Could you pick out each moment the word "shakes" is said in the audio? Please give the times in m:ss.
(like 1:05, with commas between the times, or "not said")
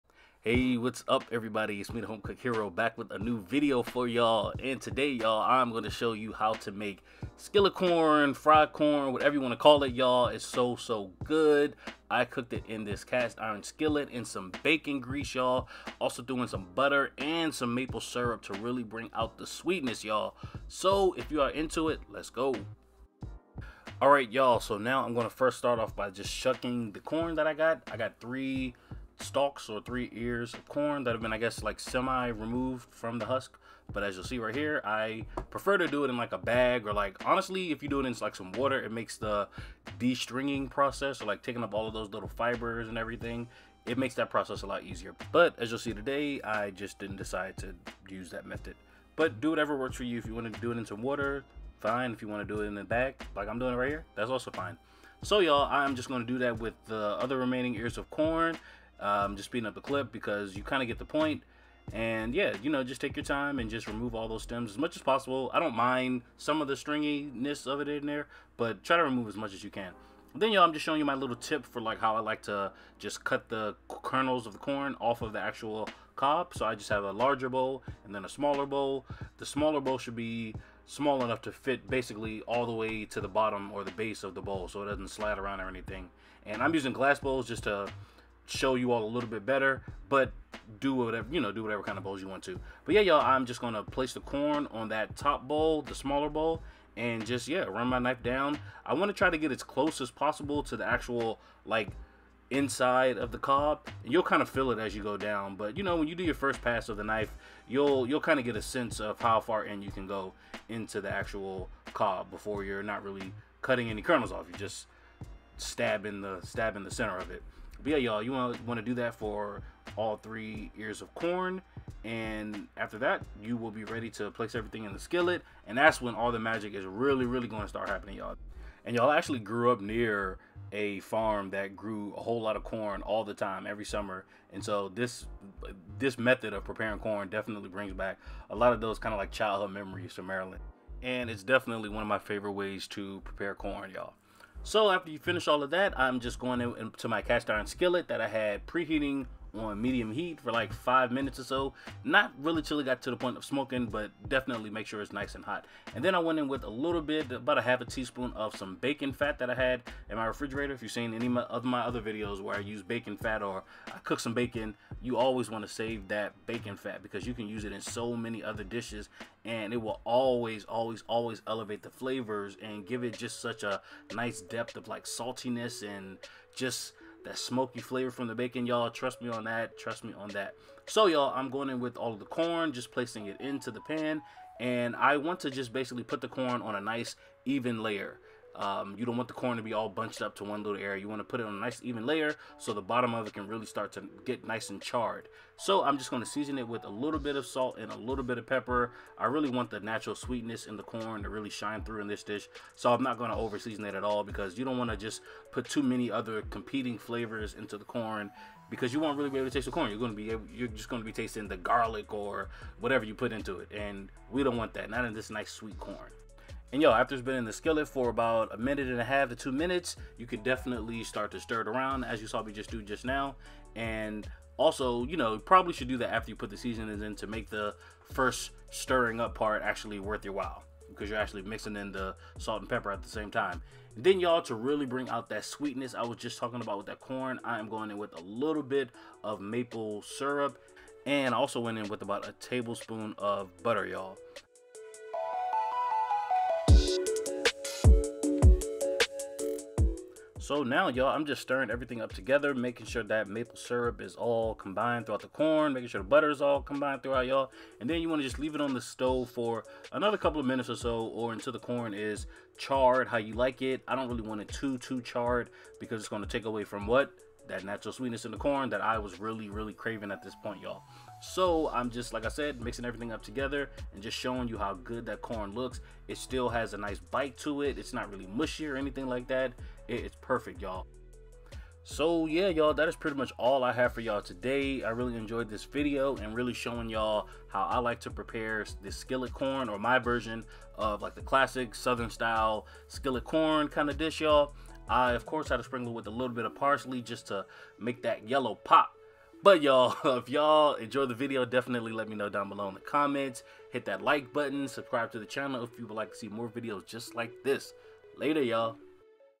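not said.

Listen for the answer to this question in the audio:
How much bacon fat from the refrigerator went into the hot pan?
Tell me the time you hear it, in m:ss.
2:37.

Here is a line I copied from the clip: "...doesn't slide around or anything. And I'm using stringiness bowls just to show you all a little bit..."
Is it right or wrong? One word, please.
wrong.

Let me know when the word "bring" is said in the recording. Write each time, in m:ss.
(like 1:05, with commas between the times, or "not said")
0:18, 2:17, 3:54.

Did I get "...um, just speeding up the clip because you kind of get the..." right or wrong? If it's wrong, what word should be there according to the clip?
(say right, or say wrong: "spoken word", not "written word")
right.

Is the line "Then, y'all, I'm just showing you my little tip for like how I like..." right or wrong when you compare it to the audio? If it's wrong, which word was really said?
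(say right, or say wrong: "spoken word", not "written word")
right.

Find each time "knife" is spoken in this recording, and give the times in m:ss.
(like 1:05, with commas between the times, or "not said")
1:37, 1:47.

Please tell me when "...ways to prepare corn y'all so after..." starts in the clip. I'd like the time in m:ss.
2:22.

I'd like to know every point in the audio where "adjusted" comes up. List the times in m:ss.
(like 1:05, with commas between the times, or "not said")
not said.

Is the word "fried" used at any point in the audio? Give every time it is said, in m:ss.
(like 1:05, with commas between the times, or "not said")
0:08.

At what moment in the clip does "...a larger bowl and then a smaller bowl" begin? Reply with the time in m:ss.
1:17.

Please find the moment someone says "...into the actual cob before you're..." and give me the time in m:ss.
1:50.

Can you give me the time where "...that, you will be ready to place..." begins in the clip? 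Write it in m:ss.
2:02.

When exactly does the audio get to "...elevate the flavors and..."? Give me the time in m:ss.
2:51.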